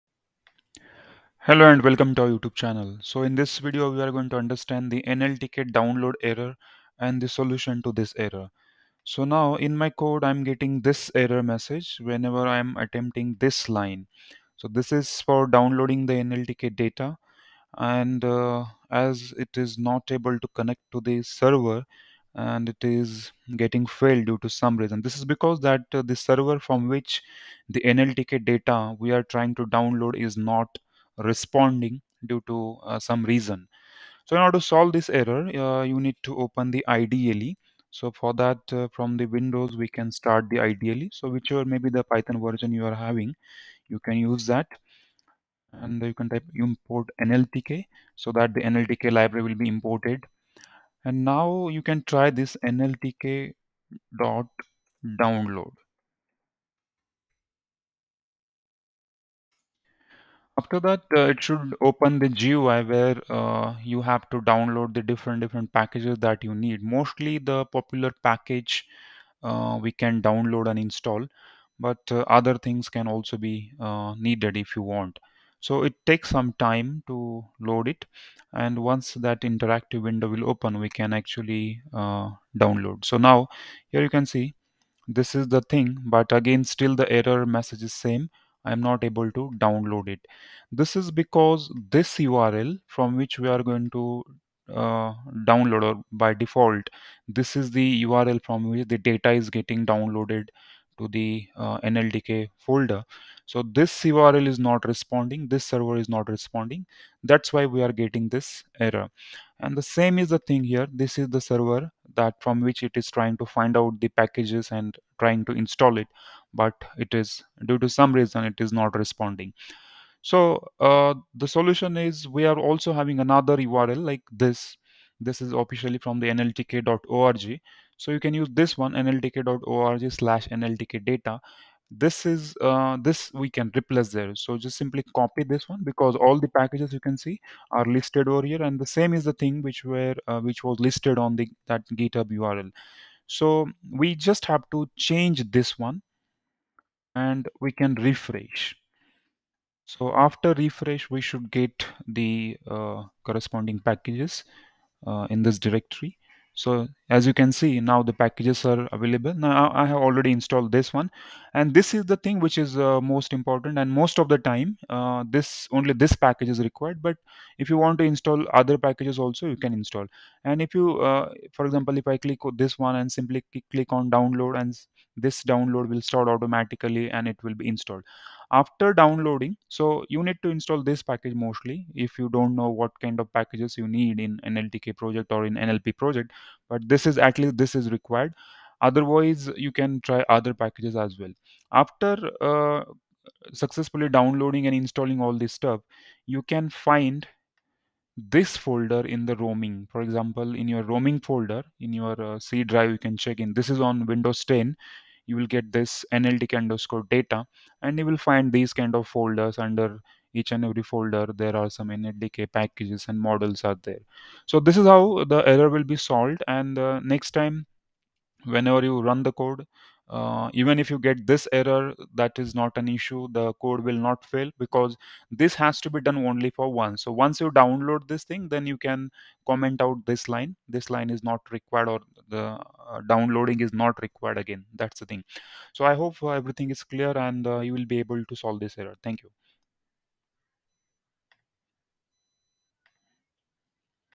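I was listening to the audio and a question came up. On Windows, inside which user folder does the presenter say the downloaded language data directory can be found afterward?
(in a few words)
roaming folder.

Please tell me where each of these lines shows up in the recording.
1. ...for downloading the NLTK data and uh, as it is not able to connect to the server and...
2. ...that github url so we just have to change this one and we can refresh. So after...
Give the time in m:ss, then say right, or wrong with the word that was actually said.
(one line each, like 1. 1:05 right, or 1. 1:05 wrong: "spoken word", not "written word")
1. 0:15 right
2. 2:21 right.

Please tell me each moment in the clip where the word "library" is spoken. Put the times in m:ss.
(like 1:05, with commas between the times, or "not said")
0:49.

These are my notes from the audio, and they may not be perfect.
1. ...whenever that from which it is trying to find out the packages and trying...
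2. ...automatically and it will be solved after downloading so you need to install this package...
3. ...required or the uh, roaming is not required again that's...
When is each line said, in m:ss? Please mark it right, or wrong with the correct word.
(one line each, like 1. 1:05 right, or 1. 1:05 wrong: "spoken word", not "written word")
1. 1:51 wrong: "server", not "whenever"
2. 2:56 wrong: "installed", not "solved"
3. 3:51 wrong: "downloading", not "roaming".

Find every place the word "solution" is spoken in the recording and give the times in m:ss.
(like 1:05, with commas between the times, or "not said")
0:07, 2:01.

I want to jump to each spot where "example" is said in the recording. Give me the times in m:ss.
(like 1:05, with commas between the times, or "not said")
2:51, 3:20.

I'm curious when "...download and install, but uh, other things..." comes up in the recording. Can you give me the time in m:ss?
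1:10.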